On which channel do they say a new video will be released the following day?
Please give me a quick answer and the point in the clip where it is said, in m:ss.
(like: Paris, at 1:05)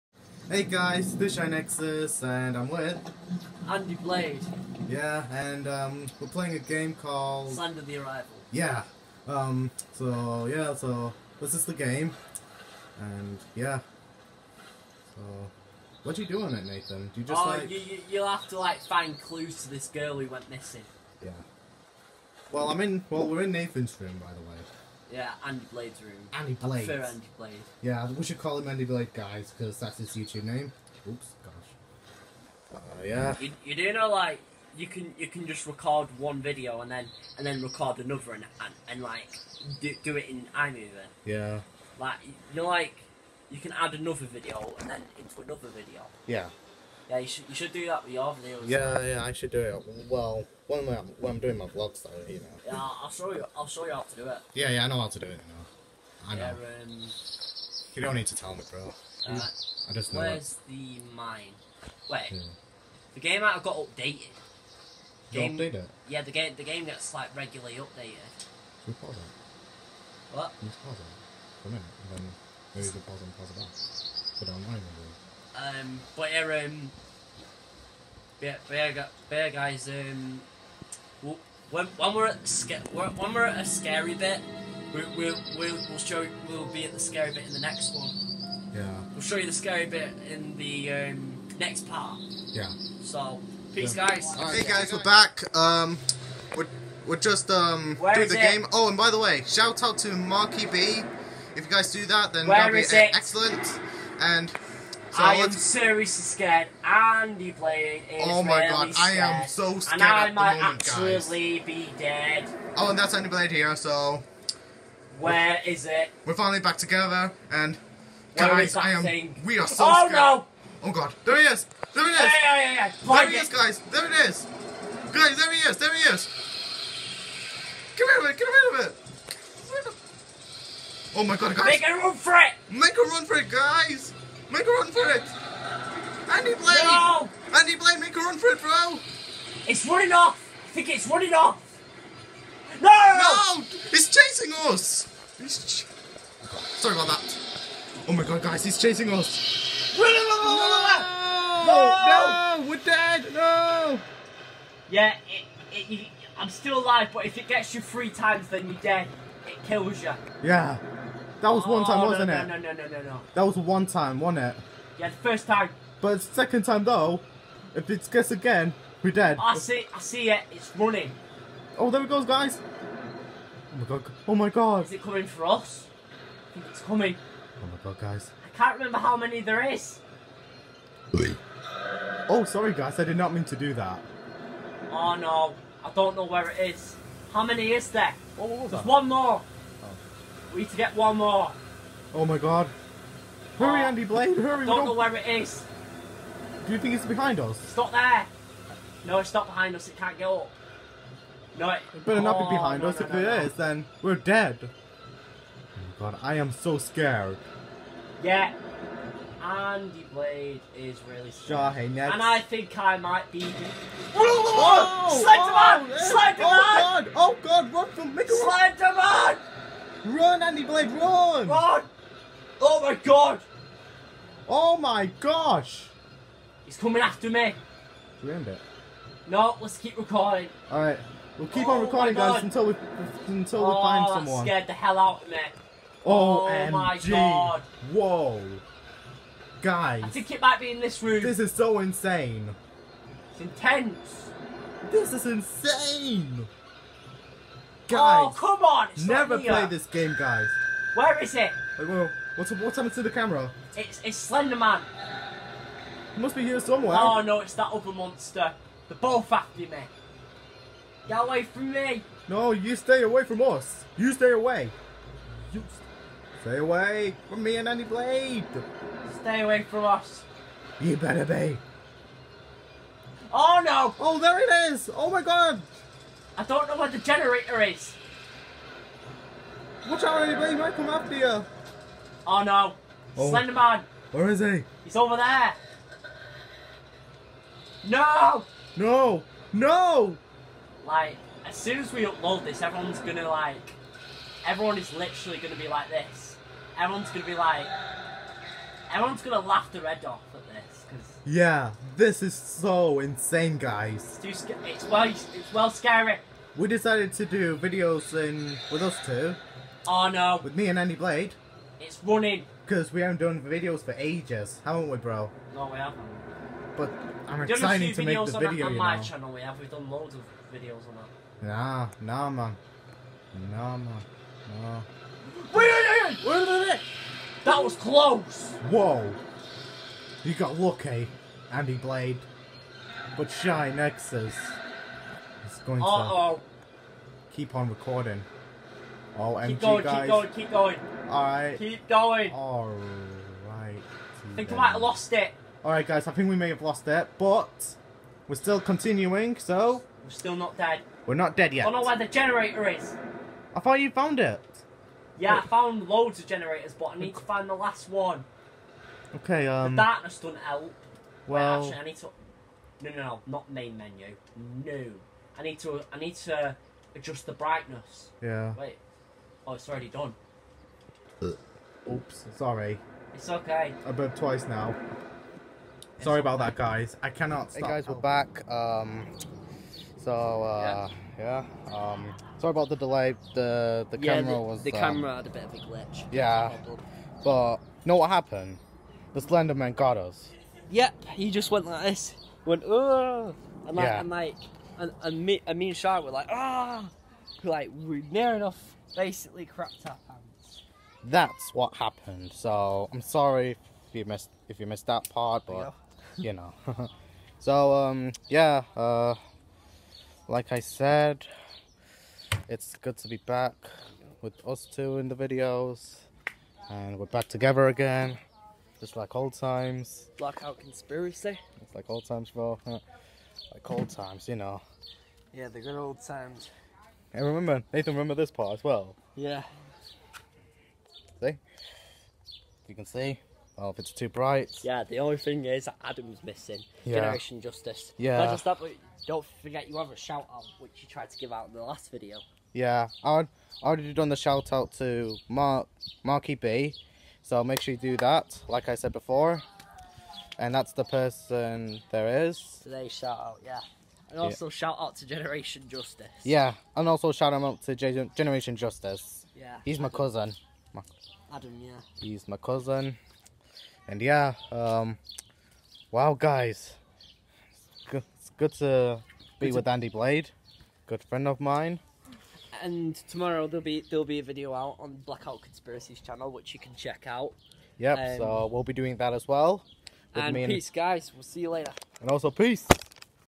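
Blackout Conspiracy, at 7:55.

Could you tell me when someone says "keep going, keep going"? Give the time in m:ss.
5:40.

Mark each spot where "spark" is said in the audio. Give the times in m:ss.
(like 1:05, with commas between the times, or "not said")
not said.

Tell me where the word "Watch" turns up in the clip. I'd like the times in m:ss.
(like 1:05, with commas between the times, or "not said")
4:39.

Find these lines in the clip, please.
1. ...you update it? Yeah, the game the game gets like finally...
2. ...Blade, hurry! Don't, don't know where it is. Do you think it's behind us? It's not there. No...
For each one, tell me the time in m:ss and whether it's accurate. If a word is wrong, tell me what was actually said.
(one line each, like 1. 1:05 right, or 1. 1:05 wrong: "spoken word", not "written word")
1. 1:05 wrong: "regularly", not "finally"
2. 3:14 right.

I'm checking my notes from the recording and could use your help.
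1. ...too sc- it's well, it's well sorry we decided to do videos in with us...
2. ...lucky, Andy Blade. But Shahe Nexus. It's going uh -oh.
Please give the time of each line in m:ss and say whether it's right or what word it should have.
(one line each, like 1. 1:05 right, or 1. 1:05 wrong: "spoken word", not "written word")
1. 5:04 wrong: "scary", not "sorry"
2. 5:30 right.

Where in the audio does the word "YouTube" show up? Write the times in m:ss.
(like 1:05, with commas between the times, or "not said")
0:30.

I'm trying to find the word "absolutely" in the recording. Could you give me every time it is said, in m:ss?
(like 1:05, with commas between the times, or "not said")
1:50.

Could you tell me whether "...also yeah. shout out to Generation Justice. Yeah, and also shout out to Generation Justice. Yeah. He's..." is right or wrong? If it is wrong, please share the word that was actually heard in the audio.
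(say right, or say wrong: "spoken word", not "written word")
right.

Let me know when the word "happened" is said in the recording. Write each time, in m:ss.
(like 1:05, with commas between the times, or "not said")
4:12, 6:28, 6:41.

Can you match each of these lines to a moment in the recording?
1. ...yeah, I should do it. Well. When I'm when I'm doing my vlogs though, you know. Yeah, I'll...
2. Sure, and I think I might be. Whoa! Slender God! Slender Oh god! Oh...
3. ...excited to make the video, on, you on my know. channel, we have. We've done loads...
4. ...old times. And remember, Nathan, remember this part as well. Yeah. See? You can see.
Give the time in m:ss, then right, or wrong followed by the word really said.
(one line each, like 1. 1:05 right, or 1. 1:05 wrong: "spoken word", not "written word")
1. 0:49 right
2. 3:31 wrong: "Man", not "God"
3. 5:17 right
4. 7:05 right.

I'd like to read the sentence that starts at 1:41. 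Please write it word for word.
If you guys do that, then that'll be it?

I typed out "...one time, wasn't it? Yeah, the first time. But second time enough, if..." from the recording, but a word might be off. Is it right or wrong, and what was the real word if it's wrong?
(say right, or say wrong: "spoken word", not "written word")
wrong: "though", not "enough".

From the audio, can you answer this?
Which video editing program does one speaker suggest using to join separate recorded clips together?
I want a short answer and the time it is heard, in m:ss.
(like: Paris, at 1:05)
iMovie, at 0:40.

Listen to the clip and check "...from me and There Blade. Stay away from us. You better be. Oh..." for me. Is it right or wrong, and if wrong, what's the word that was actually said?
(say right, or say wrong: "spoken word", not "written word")
wrong: "Andy", not "There".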